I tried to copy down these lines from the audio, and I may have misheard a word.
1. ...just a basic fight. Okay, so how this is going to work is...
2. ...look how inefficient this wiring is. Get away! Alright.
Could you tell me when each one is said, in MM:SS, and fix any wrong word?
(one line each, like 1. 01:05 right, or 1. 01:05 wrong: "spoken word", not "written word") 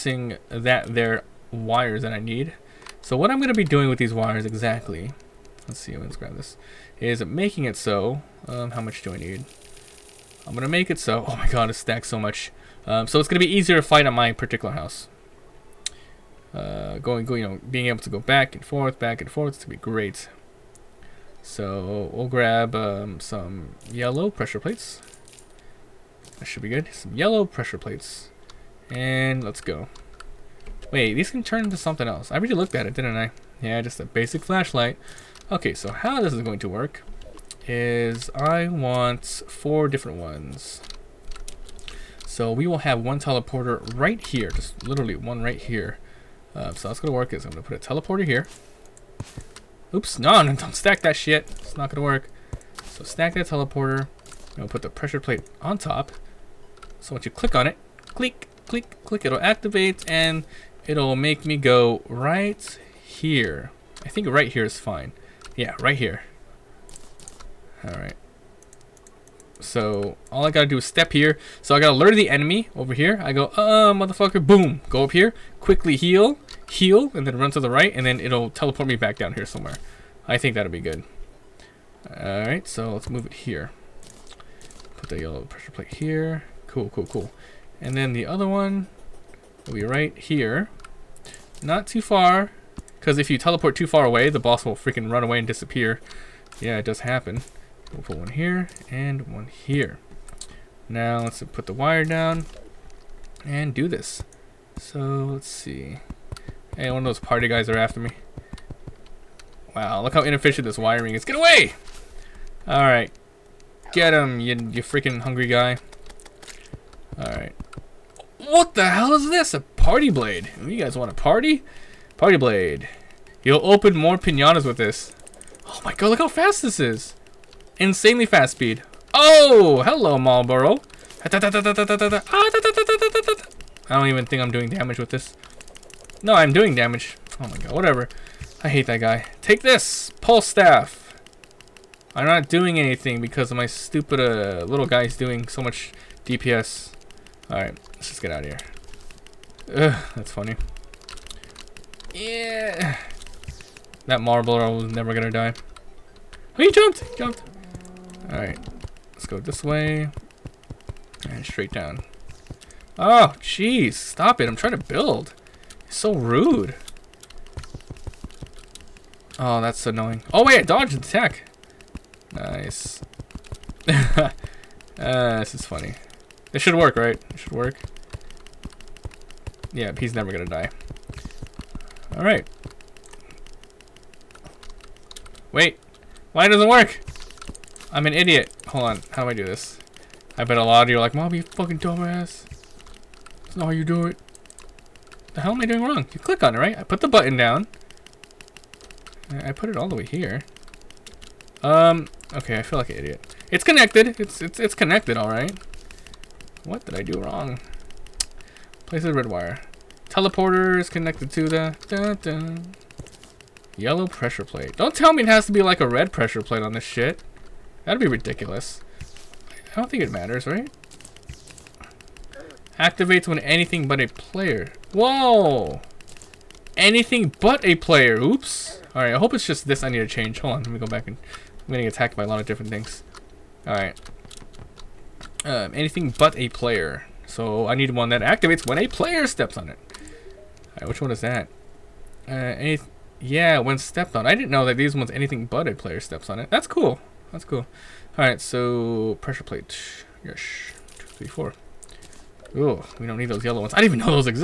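1. 00:33 wrong: "flashlight", not "fight"
2. 01:50 right.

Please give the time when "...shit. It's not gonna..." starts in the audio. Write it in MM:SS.
00:51.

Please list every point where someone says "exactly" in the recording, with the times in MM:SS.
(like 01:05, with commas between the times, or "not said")
00:04.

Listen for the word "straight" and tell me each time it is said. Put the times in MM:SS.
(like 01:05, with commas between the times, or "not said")
02:41.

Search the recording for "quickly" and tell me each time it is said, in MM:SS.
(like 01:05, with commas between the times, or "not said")
01:15.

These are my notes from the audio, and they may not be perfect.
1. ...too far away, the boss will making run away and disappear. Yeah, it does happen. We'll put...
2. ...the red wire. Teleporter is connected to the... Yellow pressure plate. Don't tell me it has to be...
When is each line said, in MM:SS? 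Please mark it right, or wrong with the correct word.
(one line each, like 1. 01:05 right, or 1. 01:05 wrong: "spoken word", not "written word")
1. 01:33 wrong: "freaking", not "making"
2. 03:29 right.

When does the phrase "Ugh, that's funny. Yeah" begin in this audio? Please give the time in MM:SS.
02:29.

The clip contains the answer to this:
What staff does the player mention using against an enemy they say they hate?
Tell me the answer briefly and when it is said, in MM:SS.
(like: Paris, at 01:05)
Pulse staff, at 02:20.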